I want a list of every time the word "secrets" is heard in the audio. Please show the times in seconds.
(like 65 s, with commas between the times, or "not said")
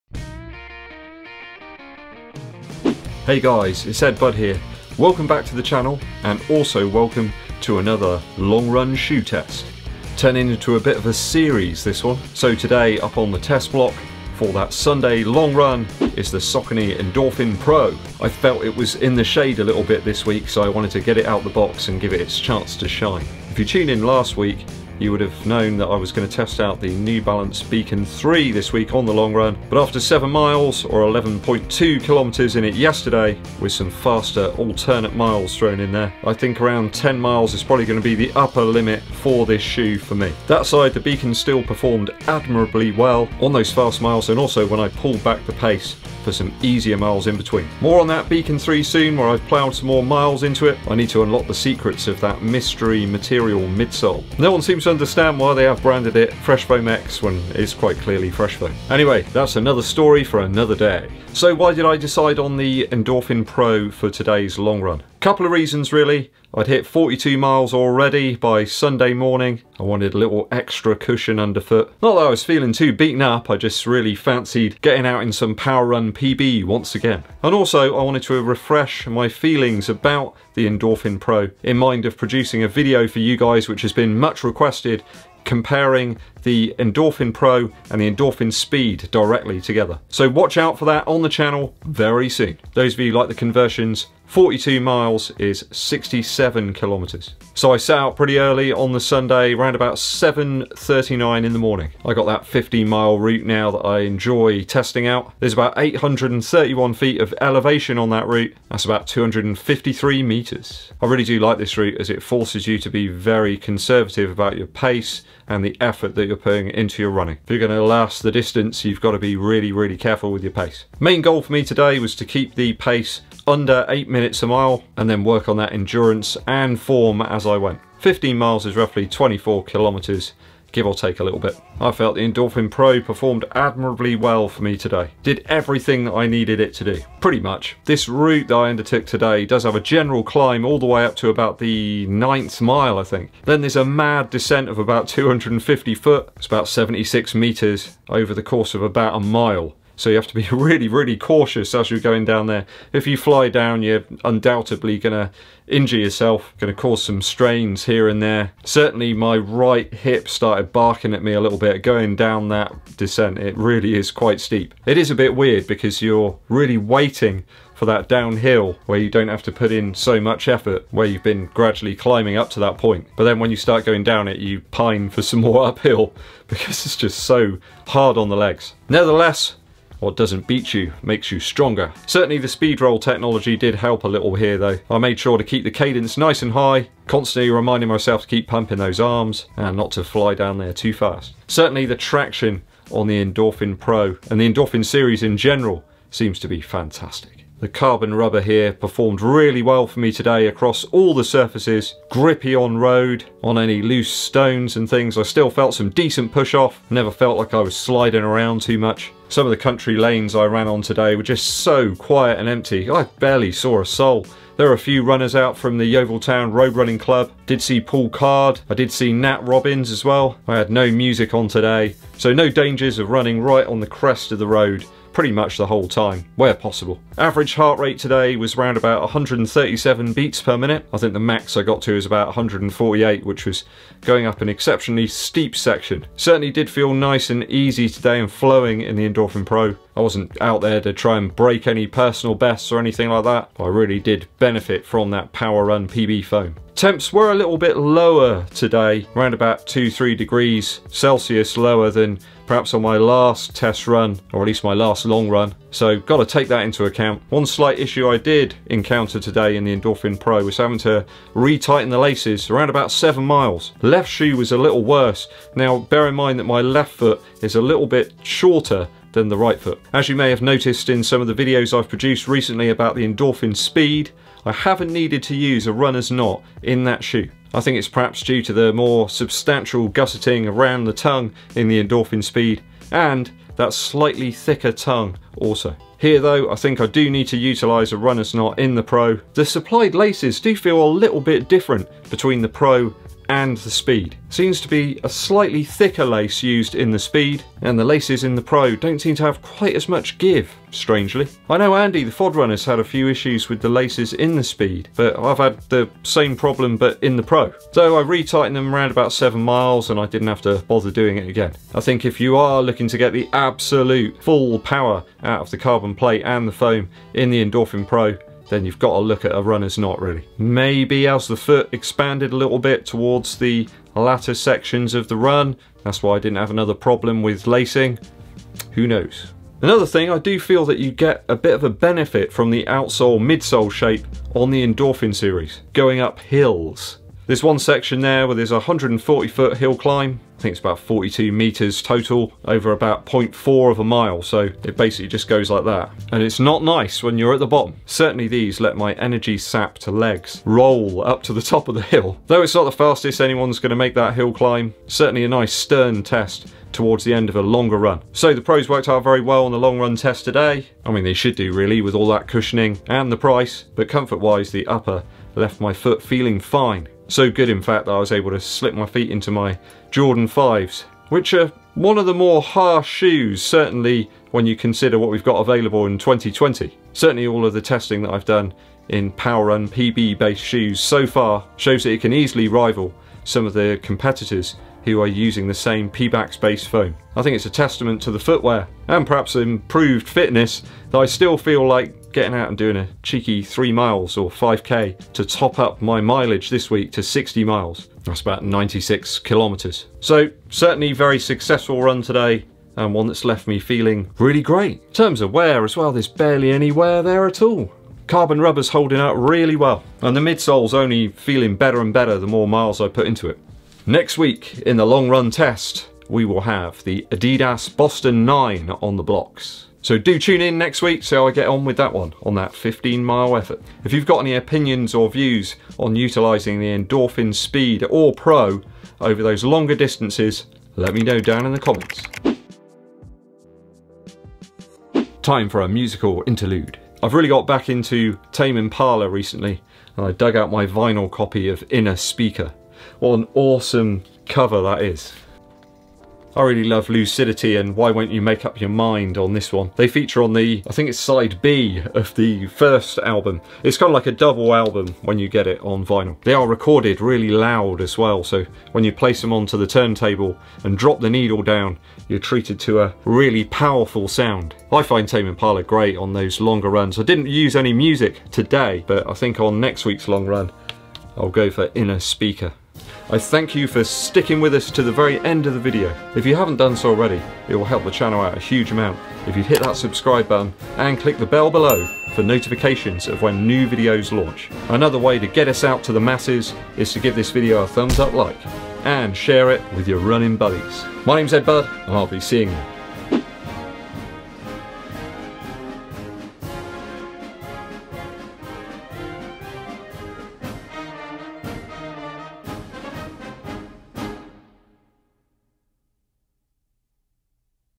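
51 s.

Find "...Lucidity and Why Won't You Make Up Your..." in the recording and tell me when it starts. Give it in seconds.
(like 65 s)
446 s.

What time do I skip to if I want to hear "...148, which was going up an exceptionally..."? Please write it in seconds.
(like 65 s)
232 s.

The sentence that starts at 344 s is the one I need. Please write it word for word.
So it basically just goes like that.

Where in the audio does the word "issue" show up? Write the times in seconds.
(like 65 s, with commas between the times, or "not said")
257 s, 303 s.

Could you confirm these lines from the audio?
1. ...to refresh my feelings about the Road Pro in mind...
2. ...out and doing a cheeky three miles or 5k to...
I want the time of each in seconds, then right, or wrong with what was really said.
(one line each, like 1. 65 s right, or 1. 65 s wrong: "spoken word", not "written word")
1. 78 s wrong: "Endorphin", not "Road"
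2. 392 s right.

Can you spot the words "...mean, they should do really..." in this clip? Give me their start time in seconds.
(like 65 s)
360 s.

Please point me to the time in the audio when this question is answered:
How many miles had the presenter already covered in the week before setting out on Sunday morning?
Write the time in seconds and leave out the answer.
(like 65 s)
66 s.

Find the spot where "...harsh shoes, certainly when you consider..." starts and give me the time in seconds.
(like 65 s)
372 s.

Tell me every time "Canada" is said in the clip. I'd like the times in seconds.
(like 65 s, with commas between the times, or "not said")
not said.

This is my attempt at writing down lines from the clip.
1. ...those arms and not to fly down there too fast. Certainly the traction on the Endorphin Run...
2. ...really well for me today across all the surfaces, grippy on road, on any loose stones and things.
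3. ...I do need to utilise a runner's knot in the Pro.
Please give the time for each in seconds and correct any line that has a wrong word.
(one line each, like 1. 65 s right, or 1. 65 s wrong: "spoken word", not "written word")
1. 188 s wrong: "Pro", not "Run"
2. 199 s right
3. 286 s right.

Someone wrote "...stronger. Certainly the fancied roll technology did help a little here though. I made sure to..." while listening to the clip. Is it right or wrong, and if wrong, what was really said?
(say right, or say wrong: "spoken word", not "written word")
wrong: "speed", not "fancied".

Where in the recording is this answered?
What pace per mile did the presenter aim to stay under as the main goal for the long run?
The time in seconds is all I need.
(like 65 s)
123 s.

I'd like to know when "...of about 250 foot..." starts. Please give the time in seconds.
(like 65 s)
144 s.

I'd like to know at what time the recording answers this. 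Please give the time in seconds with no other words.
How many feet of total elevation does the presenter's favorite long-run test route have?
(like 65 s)
105 s.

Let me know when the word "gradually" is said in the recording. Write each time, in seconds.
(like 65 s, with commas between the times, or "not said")
171 s.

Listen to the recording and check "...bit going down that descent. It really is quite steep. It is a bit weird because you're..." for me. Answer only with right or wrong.
right.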